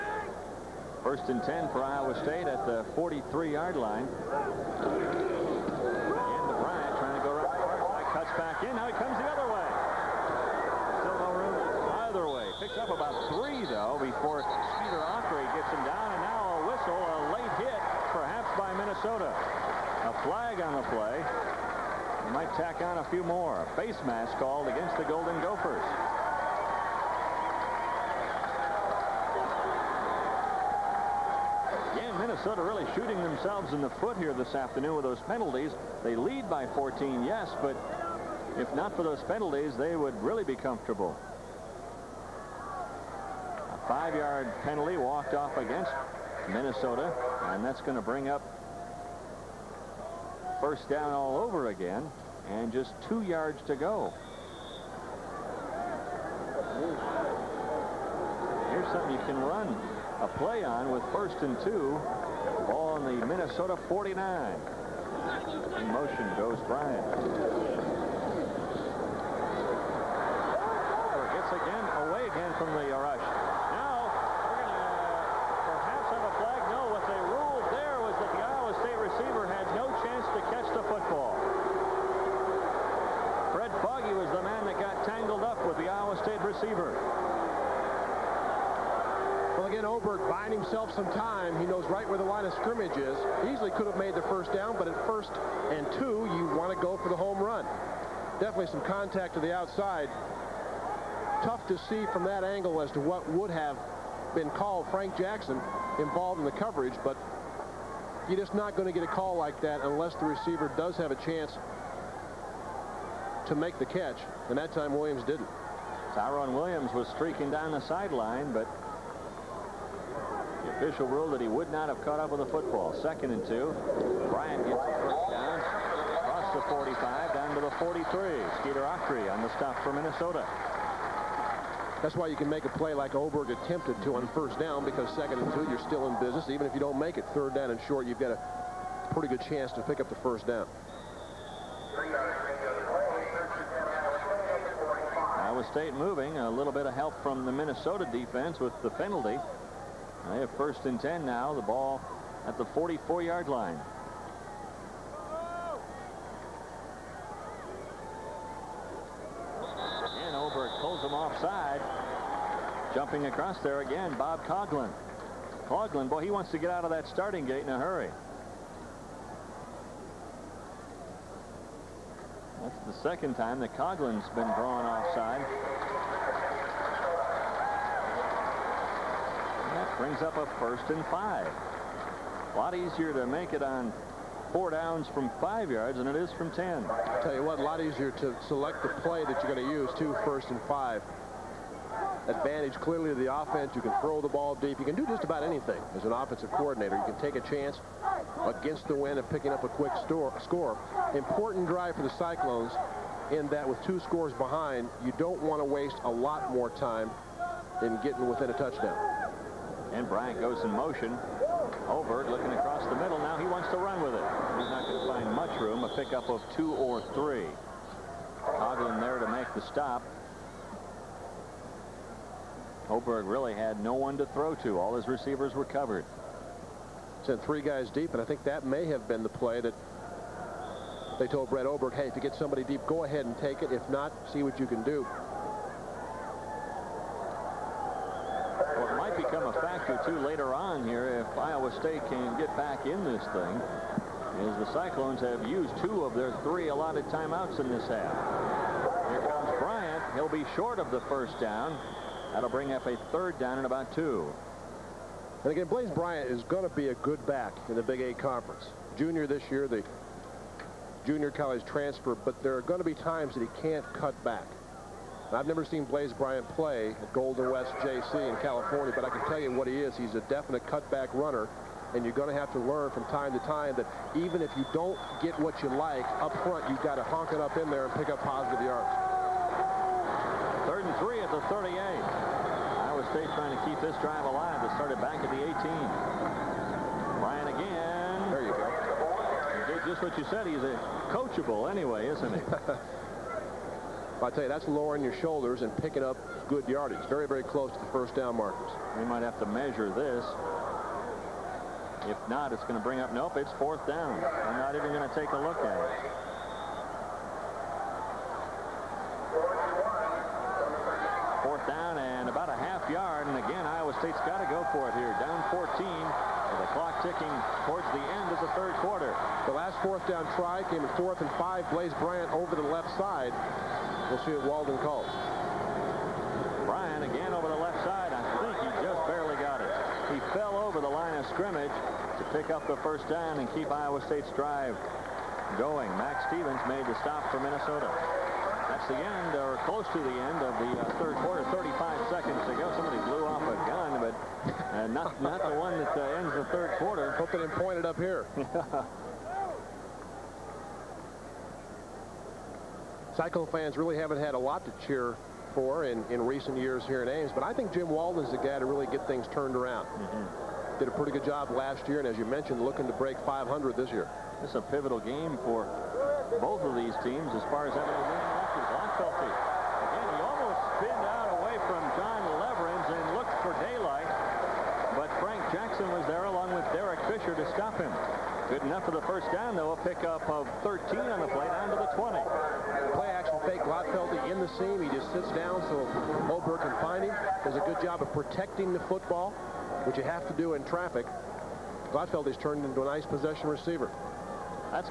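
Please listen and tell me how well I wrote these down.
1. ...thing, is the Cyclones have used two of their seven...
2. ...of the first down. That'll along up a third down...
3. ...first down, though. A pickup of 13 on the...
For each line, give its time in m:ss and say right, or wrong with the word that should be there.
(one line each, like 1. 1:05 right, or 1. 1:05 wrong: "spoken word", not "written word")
1. 4:03 wrong: "three", not "seven"
2. 4:10 wrong: "bring", not "along"
3. 6:19 right.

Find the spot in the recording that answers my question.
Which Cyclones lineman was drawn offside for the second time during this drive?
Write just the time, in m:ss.
2:44.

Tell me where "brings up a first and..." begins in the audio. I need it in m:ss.
2:59.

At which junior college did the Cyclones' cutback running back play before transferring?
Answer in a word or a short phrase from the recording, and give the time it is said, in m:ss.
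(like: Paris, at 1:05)
Golden West JC, at 4:27.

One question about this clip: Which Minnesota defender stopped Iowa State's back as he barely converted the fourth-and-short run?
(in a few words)
Max Stevens.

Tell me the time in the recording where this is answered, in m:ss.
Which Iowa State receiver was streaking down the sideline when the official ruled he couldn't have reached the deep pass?
1:56.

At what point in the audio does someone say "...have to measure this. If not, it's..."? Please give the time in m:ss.
4:59.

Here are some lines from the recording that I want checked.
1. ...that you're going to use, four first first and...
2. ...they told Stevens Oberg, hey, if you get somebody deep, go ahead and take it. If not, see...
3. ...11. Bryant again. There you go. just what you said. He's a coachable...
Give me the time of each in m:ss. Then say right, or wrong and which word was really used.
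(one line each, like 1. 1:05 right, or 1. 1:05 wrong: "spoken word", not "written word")
1. 3:09 wrong: "two", not "four"
2. 3:51 wrong: "Brett", not "Stevens"
3. 4:45 wrong: "18", not "11".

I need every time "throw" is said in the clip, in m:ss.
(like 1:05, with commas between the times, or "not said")
3:13, 3:44.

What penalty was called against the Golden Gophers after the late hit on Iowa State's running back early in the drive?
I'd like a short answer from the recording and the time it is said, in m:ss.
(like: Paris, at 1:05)
Face mask, at 0:23.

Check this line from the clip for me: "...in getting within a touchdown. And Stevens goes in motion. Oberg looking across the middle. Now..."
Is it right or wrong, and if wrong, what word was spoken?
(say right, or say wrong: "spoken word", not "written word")
wrong: "Bryant", not "Stevens".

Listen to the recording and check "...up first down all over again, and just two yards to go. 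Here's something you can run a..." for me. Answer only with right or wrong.
right.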